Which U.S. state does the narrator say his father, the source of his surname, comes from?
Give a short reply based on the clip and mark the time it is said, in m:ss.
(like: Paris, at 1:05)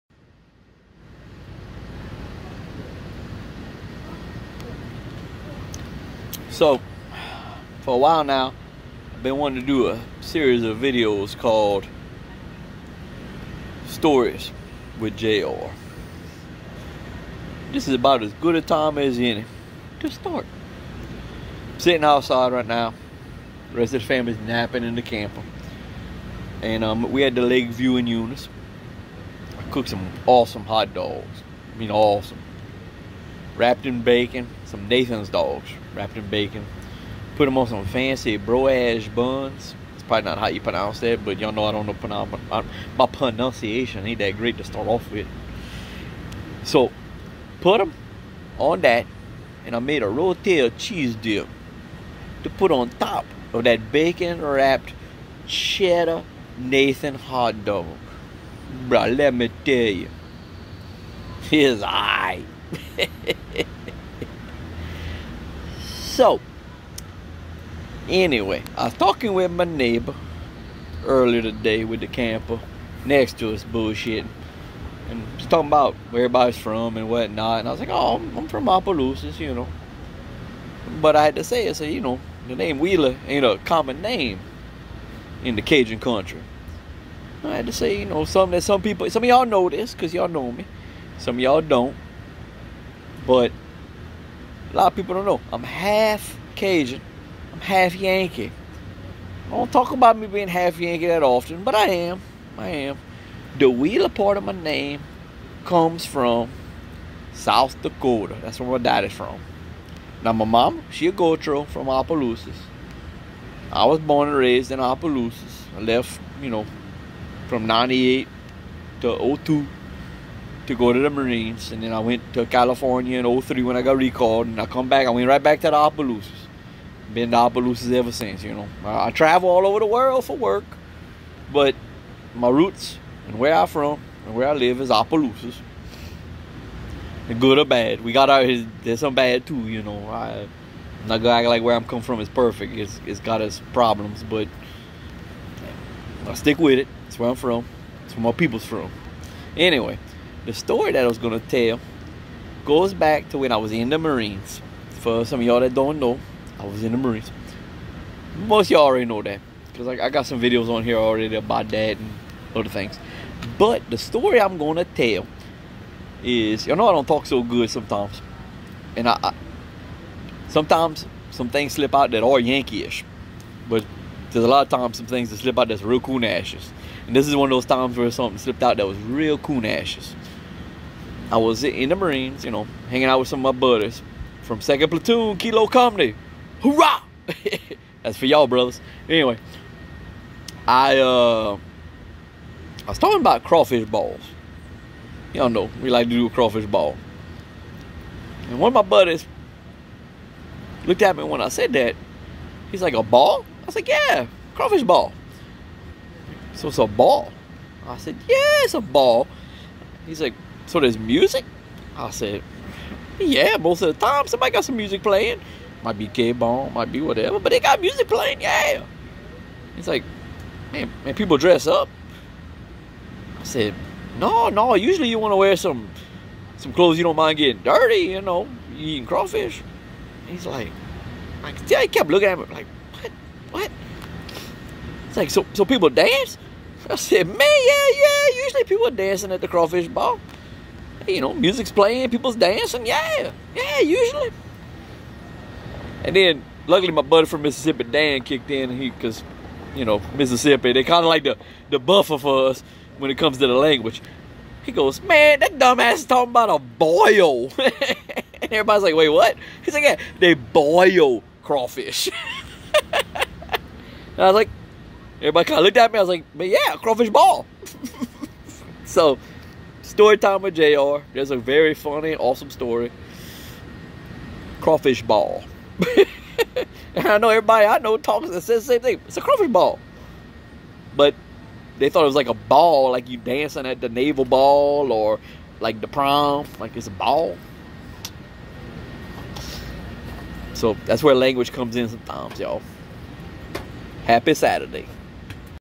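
South Dakota, at 1:47.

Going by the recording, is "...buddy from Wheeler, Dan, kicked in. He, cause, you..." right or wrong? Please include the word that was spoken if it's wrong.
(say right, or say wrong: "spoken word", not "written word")
wrong: "Mississippi", not "Wheeler".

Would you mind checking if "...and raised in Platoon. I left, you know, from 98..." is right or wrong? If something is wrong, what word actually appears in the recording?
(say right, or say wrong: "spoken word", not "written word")
wrong: "Opelousas", not "Platoon".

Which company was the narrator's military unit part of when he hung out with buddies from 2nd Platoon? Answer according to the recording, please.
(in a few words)
Kilo Company.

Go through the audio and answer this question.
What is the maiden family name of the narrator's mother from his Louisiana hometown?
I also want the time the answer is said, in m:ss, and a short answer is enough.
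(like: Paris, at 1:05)
Gautreaux, at 1:51.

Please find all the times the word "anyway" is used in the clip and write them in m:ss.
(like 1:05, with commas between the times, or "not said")
1:08, 2:29, 3:09.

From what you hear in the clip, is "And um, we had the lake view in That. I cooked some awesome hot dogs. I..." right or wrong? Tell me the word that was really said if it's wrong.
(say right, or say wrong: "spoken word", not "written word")
wrong: "Eunice", not "That".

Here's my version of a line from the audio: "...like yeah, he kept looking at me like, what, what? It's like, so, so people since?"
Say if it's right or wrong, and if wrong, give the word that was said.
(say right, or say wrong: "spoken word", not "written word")
wrong: "dance", not "since".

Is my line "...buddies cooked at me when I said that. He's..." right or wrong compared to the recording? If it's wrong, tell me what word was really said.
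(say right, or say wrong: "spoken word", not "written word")
wrong: "looked", not "cooked".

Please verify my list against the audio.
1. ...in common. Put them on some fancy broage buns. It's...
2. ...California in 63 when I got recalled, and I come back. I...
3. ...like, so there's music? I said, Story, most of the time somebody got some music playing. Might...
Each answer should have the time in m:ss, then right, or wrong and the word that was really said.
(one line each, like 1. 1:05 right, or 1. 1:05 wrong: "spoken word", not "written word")
1. 0:36 wrong: "bacon", not "common"
2. 2:02 wrong: "03", not "63"
3. 3:30 wrong: "Yeah", not "Story".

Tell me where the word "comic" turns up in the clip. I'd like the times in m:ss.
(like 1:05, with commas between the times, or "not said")
not said.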